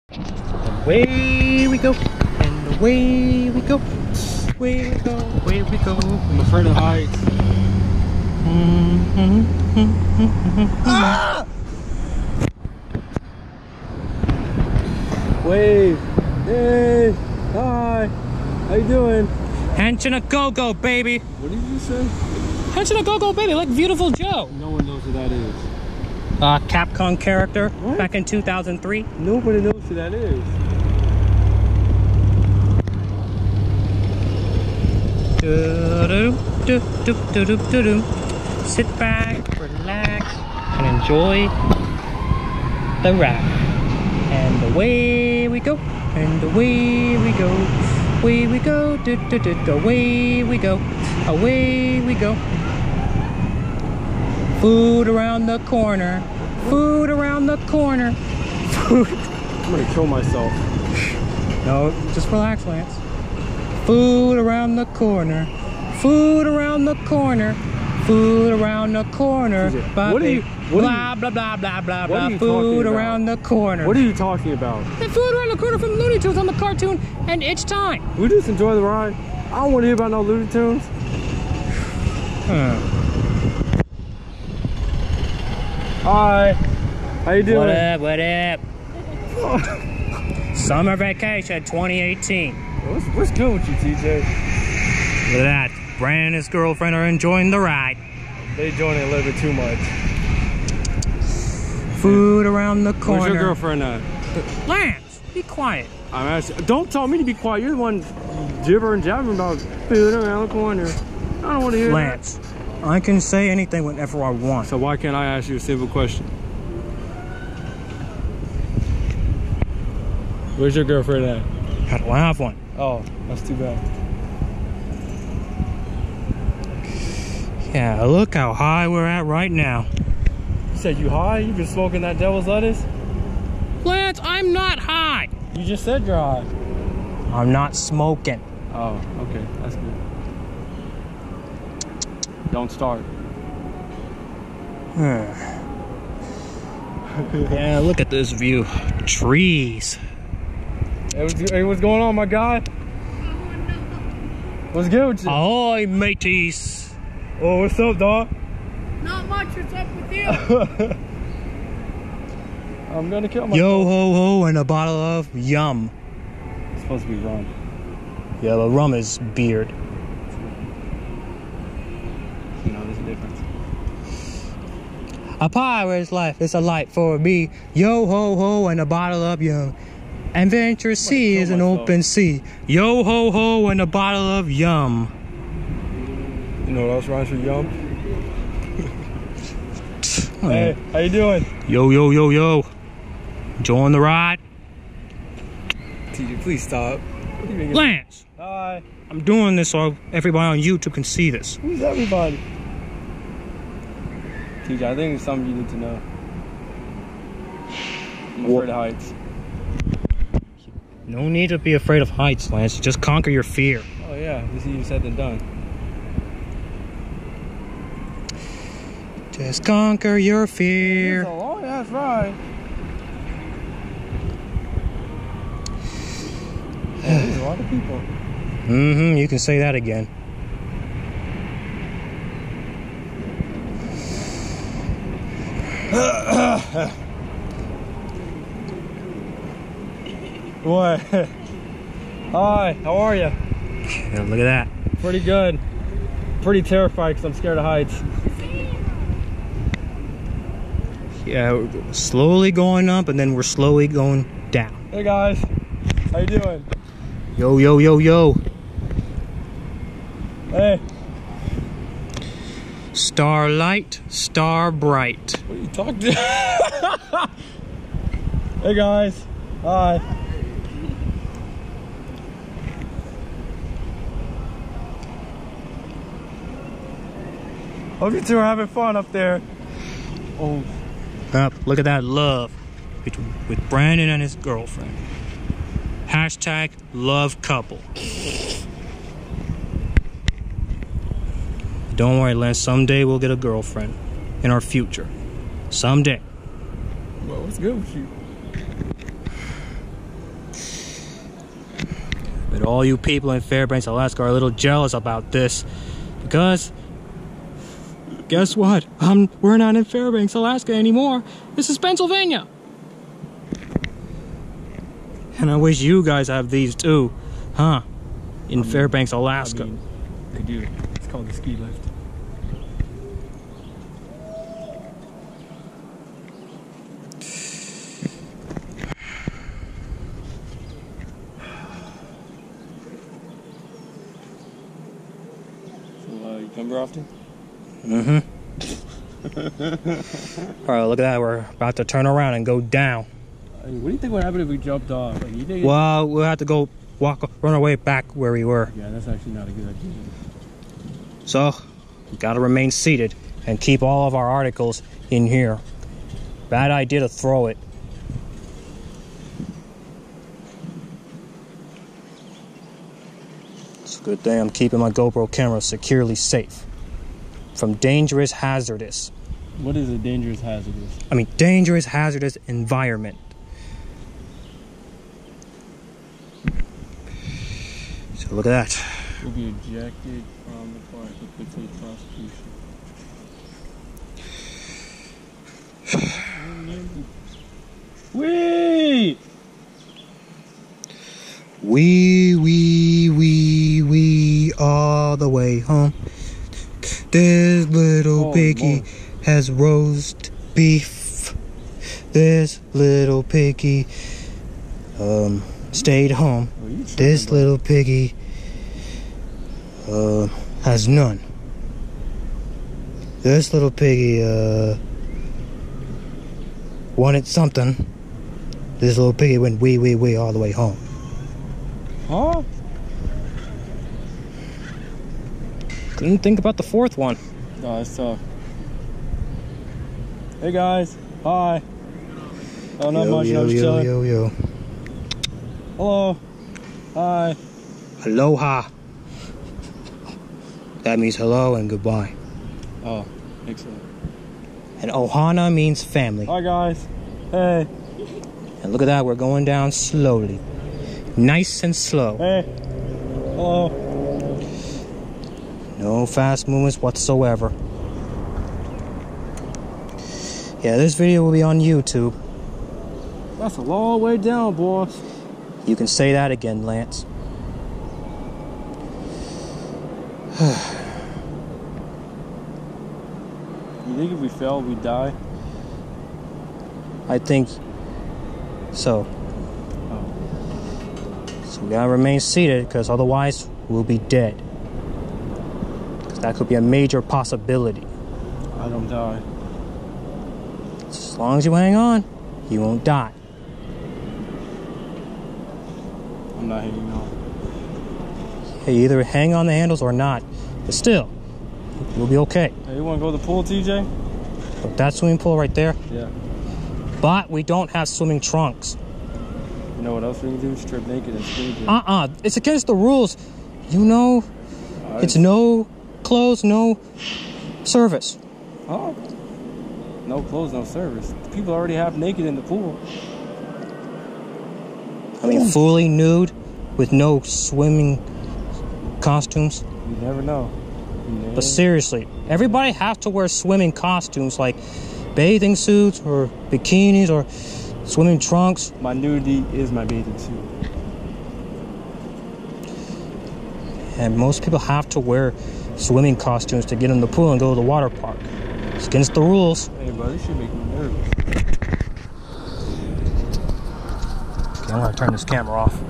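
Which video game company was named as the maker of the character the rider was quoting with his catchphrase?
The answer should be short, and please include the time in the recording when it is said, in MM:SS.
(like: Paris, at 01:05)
Capcom, at 00:26.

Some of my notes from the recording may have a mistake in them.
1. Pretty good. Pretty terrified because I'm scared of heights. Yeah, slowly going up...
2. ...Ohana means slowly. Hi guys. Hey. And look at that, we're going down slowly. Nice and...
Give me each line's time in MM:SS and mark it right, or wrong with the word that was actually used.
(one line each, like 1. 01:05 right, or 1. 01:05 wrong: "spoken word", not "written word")
1. 04:05 right
2. 07:24 wrong: "family", not "slowly".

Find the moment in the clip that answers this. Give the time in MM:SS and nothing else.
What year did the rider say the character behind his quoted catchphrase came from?
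00:28.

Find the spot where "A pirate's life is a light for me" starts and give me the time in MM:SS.
02:55.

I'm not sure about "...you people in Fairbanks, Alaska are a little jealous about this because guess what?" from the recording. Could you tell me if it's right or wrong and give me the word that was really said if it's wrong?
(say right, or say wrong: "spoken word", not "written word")
right.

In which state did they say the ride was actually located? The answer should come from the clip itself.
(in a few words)
Pennsylvania.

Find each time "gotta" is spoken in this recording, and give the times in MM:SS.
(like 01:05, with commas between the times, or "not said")
05:52, 08:01.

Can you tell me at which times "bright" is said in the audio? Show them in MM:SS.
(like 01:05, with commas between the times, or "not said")
04:24.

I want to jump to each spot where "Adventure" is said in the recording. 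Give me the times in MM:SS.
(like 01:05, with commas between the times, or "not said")
03:00.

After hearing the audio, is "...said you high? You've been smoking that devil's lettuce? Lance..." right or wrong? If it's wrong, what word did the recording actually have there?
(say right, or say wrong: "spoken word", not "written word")
right.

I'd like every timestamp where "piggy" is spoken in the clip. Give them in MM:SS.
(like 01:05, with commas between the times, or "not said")
06:38, 06:43, 06:47, 06:53, 06:59.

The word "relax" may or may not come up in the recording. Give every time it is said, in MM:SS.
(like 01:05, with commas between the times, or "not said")
00:39, 01:02.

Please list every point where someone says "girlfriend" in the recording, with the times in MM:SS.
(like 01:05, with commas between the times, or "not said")
01:36, 01:43, 02:00, 04:44, 04:53.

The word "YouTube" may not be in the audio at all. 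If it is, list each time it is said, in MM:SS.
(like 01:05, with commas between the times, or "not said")
03:20, 07:41.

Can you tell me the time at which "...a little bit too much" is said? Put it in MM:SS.
01:39.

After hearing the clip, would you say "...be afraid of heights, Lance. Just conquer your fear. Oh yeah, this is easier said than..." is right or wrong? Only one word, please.
right.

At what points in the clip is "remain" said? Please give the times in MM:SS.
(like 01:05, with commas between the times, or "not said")
05:52, 08:01.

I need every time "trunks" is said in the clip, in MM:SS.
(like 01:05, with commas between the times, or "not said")
08:28, 08:58.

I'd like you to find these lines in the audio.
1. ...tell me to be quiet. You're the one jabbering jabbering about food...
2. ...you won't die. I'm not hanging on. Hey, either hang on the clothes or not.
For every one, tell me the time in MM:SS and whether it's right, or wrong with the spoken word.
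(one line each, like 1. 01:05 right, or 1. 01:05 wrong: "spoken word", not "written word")
1. 01:46 wrong: "gibbering", not "jabbering"
2. 08:12 wrong: "handles", not "clothes".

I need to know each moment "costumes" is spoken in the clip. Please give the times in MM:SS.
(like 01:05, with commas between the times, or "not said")
08:49, 08:53, 09:06.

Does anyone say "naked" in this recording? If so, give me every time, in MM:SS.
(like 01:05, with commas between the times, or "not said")
08:30, 08:41.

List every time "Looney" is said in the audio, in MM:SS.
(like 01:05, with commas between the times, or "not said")
01:15, 01:20.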